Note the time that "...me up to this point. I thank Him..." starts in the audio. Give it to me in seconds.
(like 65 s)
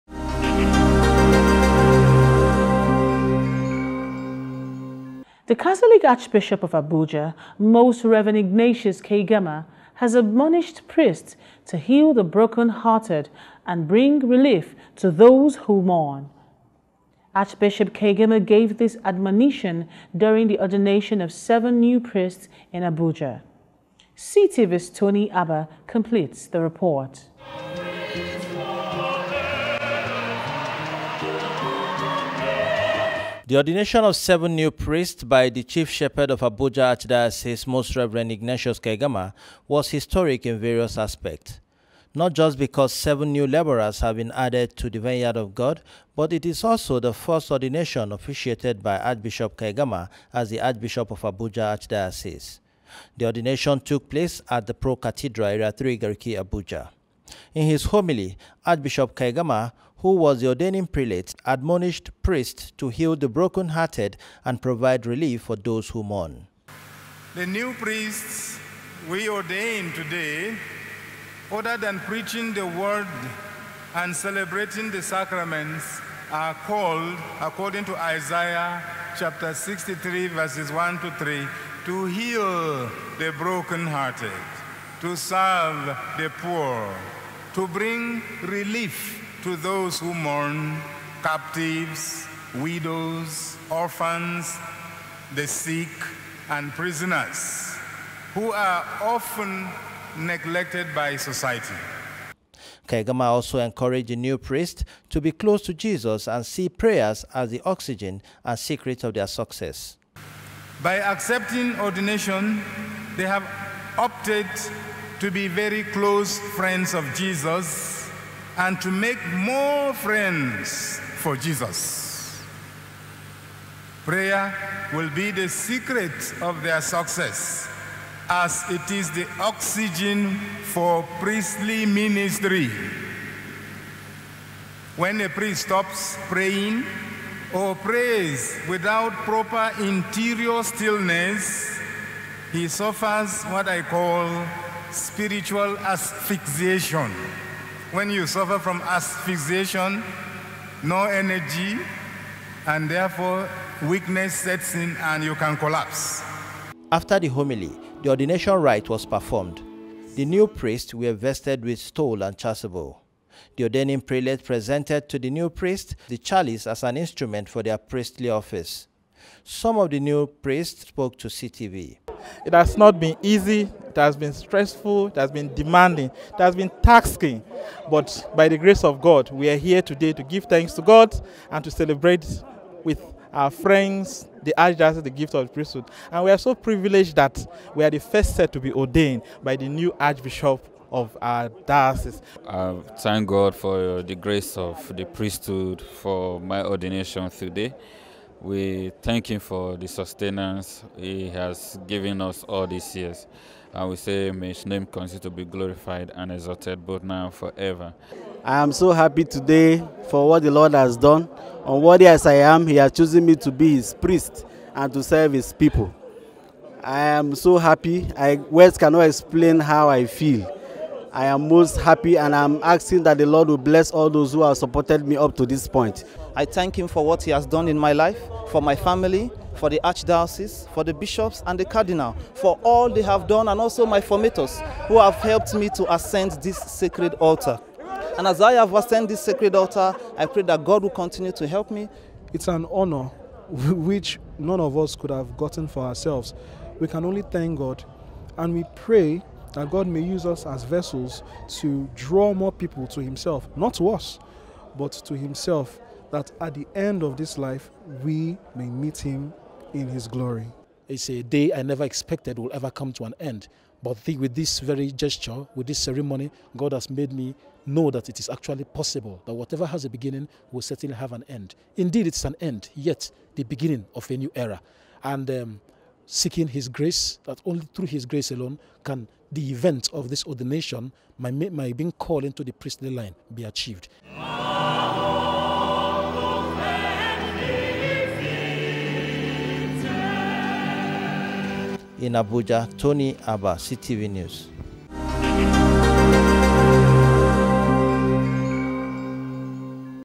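225 s.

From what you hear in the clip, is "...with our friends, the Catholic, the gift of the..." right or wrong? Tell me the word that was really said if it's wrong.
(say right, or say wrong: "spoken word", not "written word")
wrong: "Archdiocese", not "Catholic".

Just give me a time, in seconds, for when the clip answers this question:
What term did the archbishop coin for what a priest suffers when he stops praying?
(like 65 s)
144 s.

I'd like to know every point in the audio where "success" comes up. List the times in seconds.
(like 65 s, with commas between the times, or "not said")
109 s, 126 s.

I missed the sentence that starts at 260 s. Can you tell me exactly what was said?
It's a day I never expected will ever come to an end.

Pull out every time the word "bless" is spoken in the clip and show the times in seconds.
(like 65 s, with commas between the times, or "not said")
223 s.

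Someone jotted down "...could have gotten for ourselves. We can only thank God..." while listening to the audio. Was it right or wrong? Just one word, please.
right.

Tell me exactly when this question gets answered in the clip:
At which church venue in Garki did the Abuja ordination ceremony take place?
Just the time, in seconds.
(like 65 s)
54 s.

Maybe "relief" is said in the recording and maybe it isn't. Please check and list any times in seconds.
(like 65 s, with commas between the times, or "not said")
14 s, 65 s, 88 s.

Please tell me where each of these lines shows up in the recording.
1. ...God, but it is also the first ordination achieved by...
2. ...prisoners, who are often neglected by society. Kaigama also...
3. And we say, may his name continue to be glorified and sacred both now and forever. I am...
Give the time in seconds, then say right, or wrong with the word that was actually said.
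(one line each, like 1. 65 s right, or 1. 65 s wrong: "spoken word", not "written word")
1. 45 s wrong: "officiated", not "achieved"
2. 96 s right
3. 203 s wrong: "exalted", not "sacred".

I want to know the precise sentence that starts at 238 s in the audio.
And as I have ascended this sacred altar, I pray that God will continue to help me.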